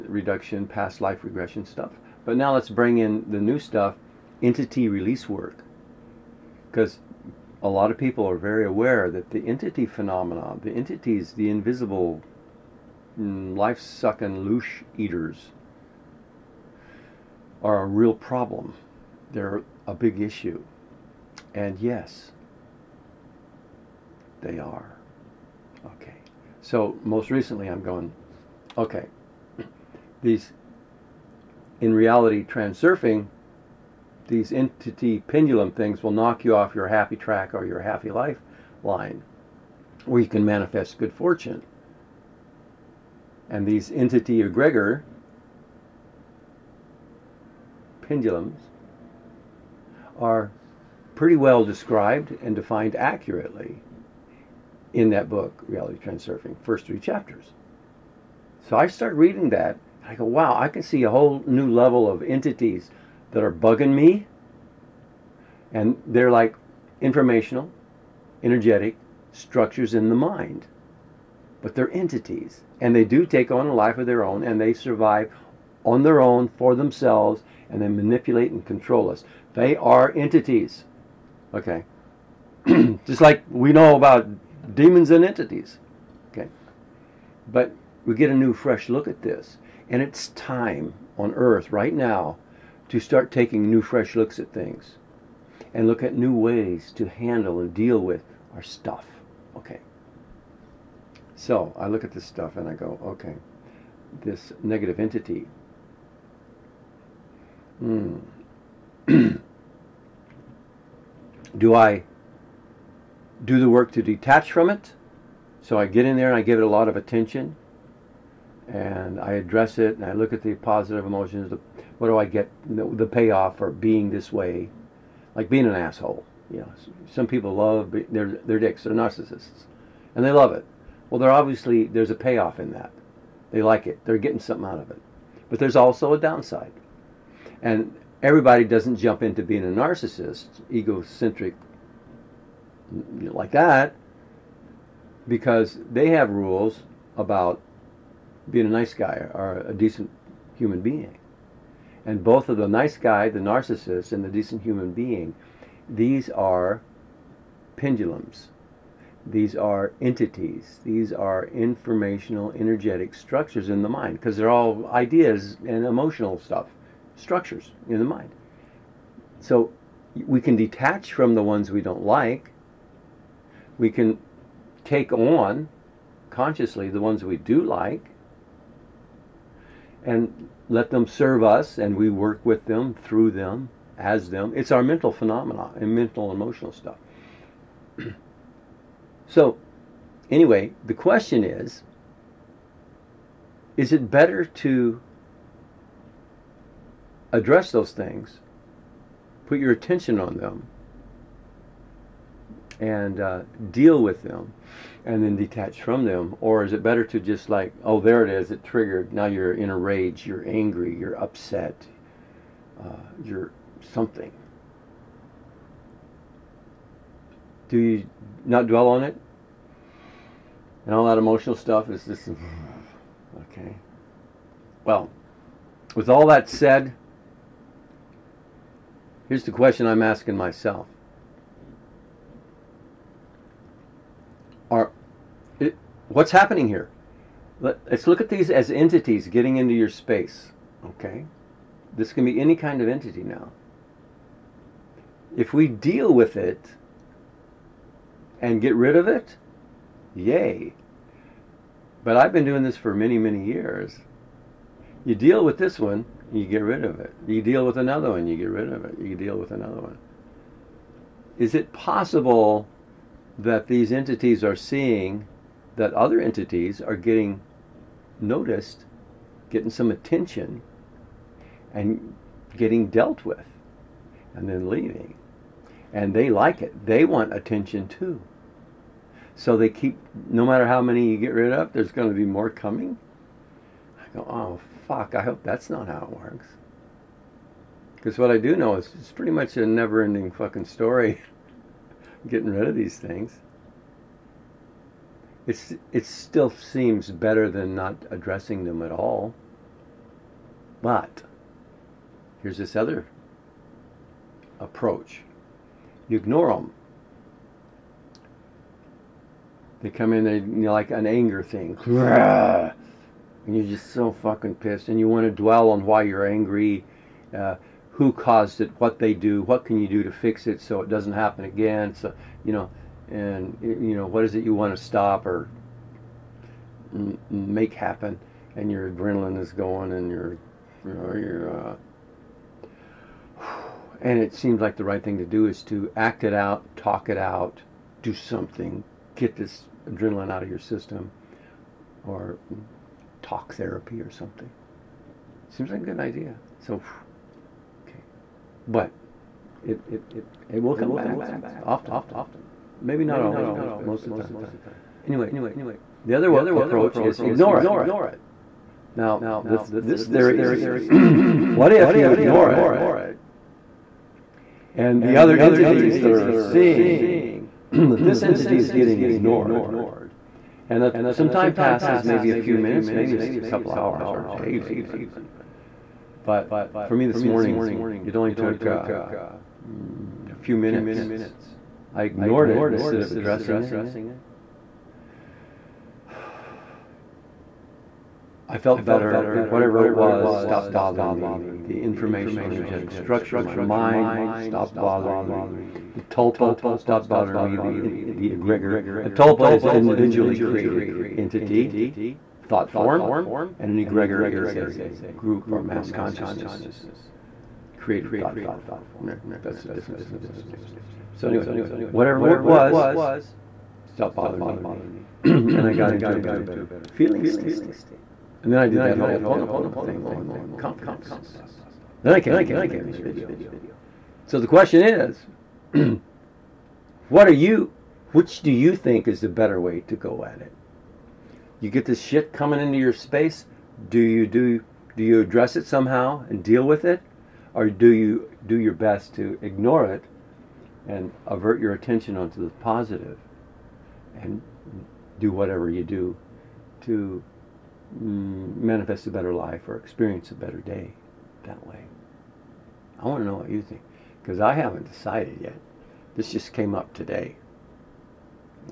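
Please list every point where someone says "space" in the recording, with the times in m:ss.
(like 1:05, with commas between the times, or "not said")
3:59, 7:12.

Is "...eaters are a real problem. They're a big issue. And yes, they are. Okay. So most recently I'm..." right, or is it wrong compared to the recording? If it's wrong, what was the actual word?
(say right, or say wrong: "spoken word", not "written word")
right.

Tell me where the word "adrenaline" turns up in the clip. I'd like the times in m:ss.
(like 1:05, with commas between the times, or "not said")
5:28, 5:39.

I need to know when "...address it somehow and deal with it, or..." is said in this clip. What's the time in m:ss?
7:15.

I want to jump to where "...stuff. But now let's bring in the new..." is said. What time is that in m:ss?
0:01.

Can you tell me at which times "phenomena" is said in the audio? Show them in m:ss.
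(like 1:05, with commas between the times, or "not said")
0:09, 3:05.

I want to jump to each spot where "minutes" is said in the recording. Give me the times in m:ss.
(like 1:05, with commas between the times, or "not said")
6:12, 6:20.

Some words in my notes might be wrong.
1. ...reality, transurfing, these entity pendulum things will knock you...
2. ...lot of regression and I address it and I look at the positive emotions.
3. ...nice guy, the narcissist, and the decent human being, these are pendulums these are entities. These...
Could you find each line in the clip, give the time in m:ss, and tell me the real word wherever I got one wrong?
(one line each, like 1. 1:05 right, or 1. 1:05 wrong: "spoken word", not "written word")
1. 0:31 right
2. 1:56 wrong: "attention", not "regression"
3. 2:32 right.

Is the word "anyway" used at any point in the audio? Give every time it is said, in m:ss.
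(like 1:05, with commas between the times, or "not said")
3:10, 5:55, 6:51.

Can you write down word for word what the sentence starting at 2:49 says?
So we can detach from the ones we don't like.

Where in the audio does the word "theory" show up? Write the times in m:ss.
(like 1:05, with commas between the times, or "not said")
6:00.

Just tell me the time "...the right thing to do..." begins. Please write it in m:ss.
5:34.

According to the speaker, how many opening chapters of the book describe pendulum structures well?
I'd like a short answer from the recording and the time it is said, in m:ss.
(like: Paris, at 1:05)
first 3 chapters, at 0:56.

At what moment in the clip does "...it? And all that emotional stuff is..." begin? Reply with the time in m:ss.
3:39.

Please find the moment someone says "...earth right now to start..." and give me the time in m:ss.
1:31.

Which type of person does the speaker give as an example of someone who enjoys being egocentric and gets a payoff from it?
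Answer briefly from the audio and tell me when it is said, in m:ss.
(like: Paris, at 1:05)
narcissists, at 2:08.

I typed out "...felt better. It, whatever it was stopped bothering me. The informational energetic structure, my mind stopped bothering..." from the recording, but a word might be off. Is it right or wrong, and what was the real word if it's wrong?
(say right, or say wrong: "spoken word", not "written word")
right.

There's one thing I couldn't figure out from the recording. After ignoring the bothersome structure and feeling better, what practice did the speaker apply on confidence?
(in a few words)
Ho'oponopono.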